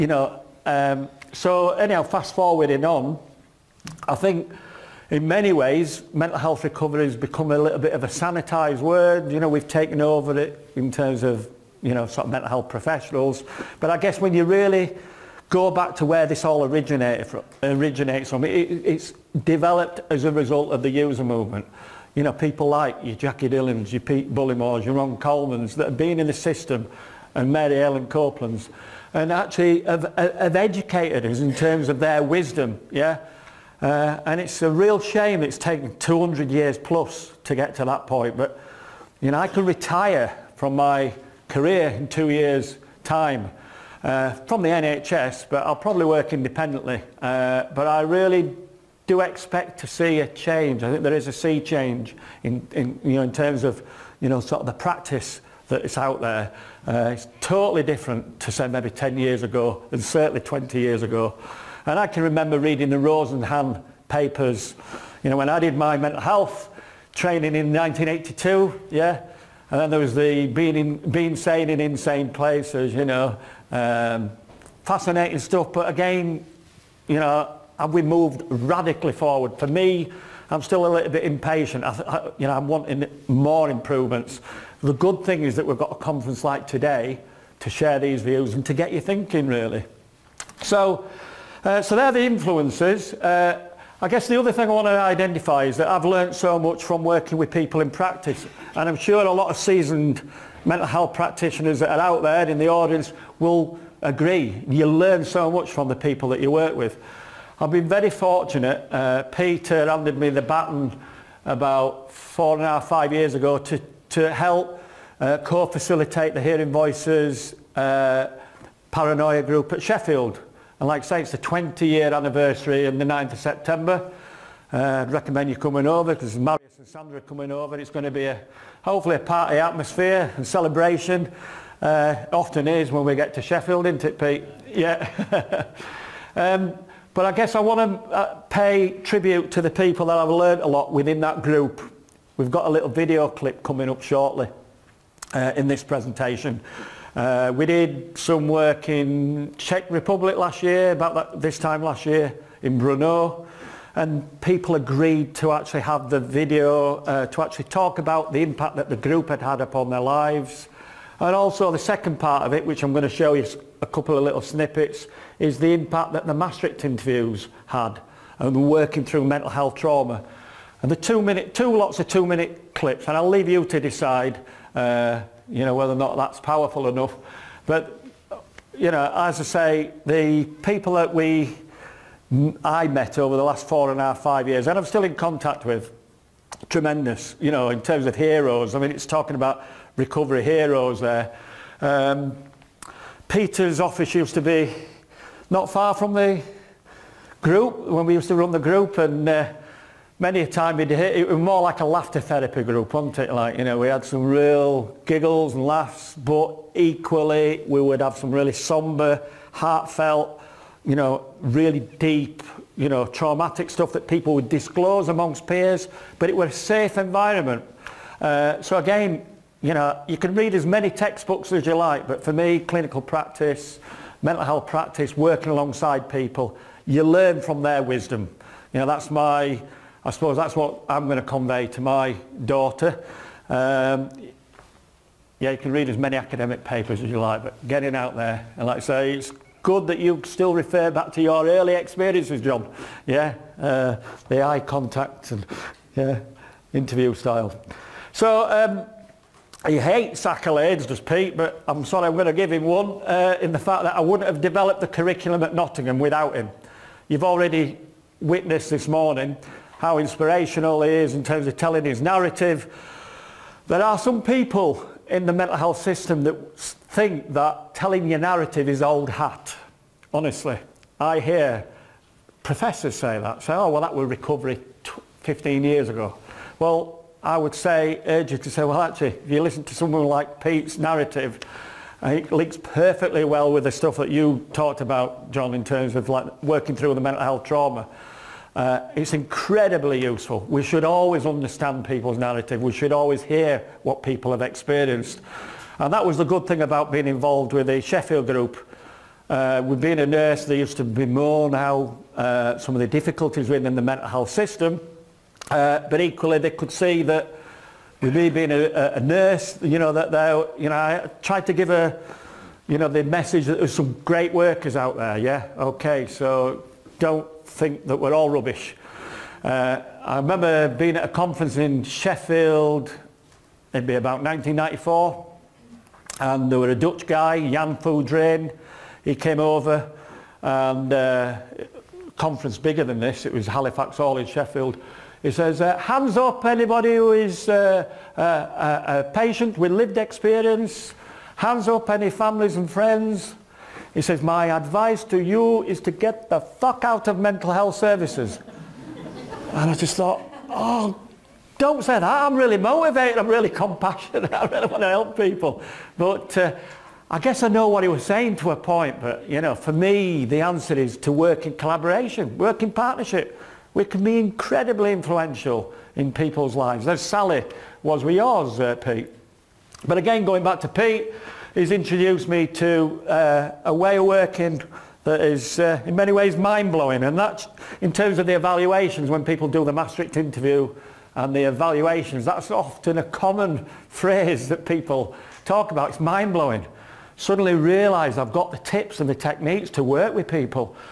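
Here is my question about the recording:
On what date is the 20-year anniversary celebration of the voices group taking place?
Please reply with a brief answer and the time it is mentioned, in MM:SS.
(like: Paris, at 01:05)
9th of September, at 02:03.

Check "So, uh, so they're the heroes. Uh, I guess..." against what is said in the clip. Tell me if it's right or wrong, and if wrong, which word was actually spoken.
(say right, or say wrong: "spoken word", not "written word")
wrong: "influences", not "heroes".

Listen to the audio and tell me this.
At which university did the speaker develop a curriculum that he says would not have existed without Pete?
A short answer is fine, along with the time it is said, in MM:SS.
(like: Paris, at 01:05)
Nottingham, at 04:15.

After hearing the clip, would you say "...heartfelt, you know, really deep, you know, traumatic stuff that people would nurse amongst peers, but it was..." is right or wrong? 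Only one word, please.
wrong.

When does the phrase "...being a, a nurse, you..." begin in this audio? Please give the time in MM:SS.
05:08.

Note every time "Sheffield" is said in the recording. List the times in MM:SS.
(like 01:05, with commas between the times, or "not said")
01:59, 02:13, 04:57, 05:21, 05:34.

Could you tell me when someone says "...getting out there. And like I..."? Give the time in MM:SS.
03:57.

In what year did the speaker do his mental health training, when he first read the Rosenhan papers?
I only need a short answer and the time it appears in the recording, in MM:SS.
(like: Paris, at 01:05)
1982, at 01:07.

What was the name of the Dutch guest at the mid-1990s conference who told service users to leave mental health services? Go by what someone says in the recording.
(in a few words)
Jan Foudraine.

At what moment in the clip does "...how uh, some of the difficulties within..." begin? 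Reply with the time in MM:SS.
05:01.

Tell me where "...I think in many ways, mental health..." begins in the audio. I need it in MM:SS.
00:04.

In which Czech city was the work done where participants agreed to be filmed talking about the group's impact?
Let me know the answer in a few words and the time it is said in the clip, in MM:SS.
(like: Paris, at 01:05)
Brno, at 02:32.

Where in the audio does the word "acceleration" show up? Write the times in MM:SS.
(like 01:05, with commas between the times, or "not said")
not said.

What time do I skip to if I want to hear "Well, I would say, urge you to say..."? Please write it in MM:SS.
04:36.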